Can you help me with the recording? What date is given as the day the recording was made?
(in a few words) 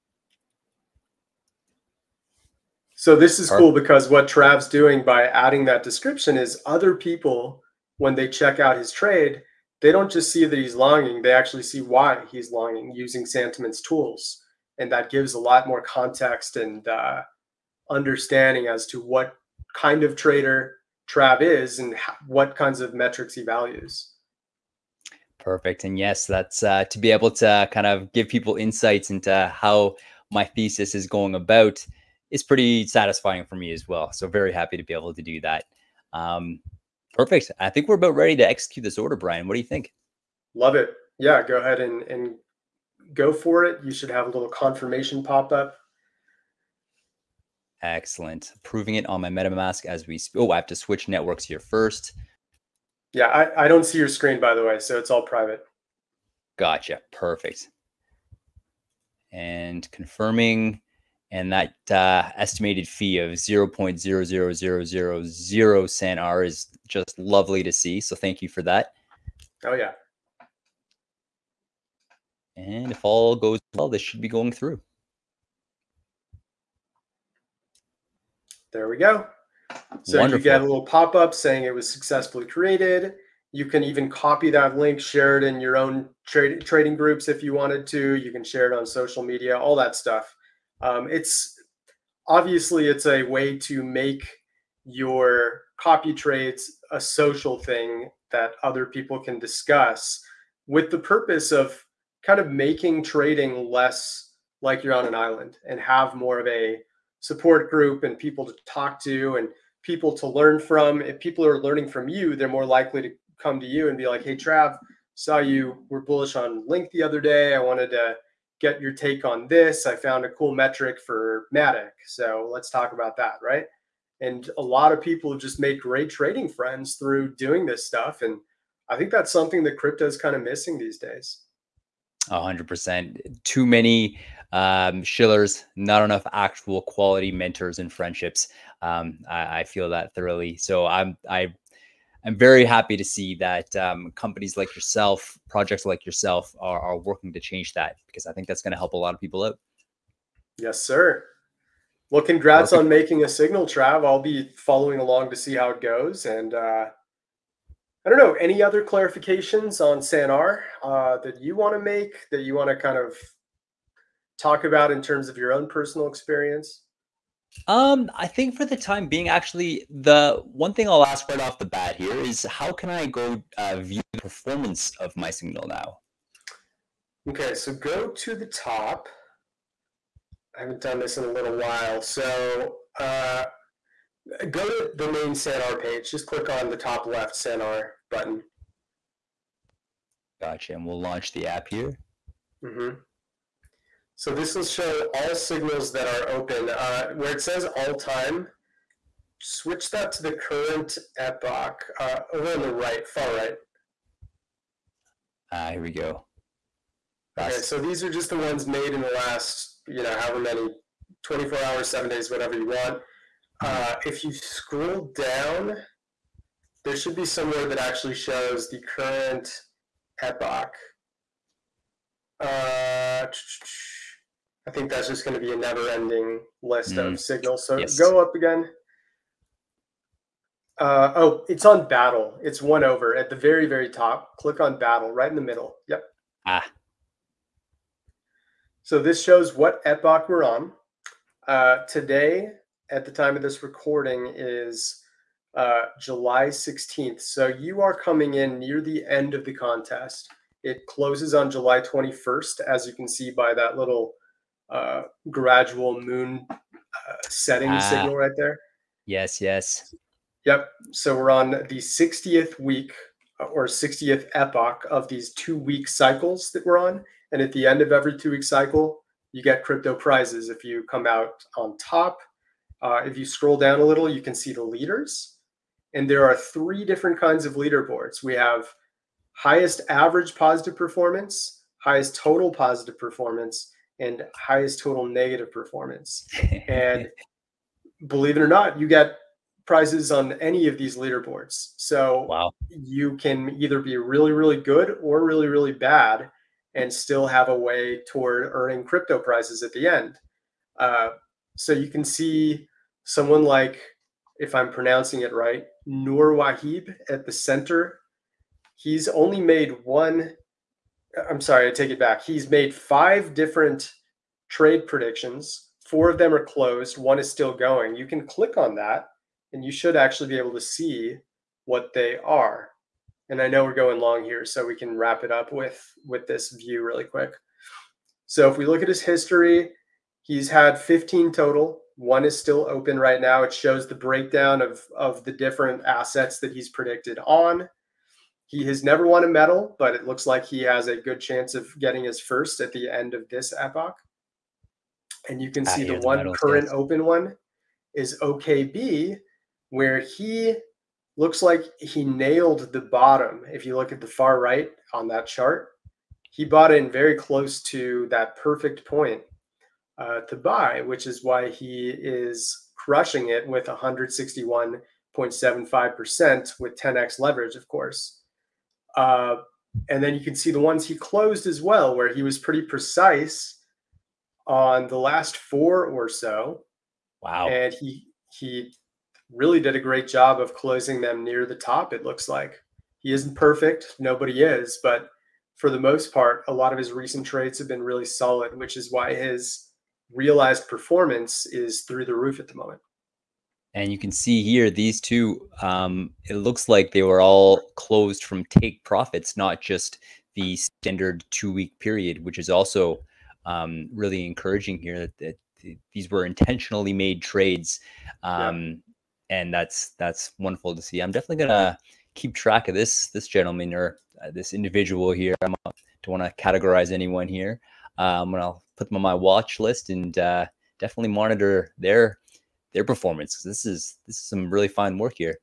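July 16th.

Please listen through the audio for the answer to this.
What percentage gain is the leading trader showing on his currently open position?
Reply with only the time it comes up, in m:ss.
6:03.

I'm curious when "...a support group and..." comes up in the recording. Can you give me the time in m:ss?
1:46.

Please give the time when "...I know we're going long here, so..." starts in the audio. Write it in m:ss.
5:23.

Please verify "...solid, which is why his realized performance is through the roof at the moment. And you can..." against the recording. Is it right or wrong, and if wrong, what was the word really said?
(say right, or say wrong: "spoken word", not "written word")
right.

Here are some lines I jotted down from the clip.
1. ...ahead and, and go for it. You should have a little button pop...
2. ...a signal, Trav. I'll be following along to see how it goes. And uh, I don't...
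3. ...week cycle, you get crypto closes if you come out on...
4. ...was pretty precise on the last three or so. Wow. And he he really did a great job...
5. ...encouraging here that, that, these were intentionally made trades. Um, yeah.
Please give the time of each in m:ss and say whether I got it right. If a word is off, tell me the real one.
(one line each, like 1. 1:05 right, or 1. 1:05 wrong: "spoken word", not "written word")
1. 0:41 wrong: "confirmation", not "button"
2. 2:33 right
3. 4:28 wrong: "prizes", not "closes"
4. 6:12 wrong: "four", not "three"
5. 6:44 right.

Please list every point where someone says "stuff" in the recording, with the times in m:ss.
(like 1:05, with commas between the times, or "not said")
1:29, 2:07.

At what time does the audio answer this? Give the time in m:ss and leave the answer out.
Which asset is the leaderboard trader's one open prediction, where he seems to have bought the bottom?
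5:48.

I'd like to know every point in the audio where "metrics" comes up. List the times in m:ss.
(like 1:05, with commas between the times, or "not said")
0:22, 2:00.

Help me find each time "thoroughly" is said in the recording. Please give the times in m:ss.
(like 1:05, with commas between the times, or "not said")
2:20.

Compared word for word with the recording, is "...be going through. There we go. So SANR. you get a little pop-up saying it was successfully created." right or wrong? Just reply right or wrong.
wrong.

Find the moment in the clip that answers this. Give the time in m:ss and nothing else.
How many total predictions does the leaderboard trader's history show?
5:30.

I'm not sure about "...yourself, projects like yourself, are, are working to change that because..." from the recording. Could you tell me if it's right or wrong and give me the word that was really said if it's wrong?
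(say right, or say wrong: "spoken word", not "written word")
right.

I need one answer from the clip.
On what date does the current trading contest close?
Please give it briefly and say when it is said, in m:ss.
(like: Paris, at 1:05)
July 21st, at 4:11.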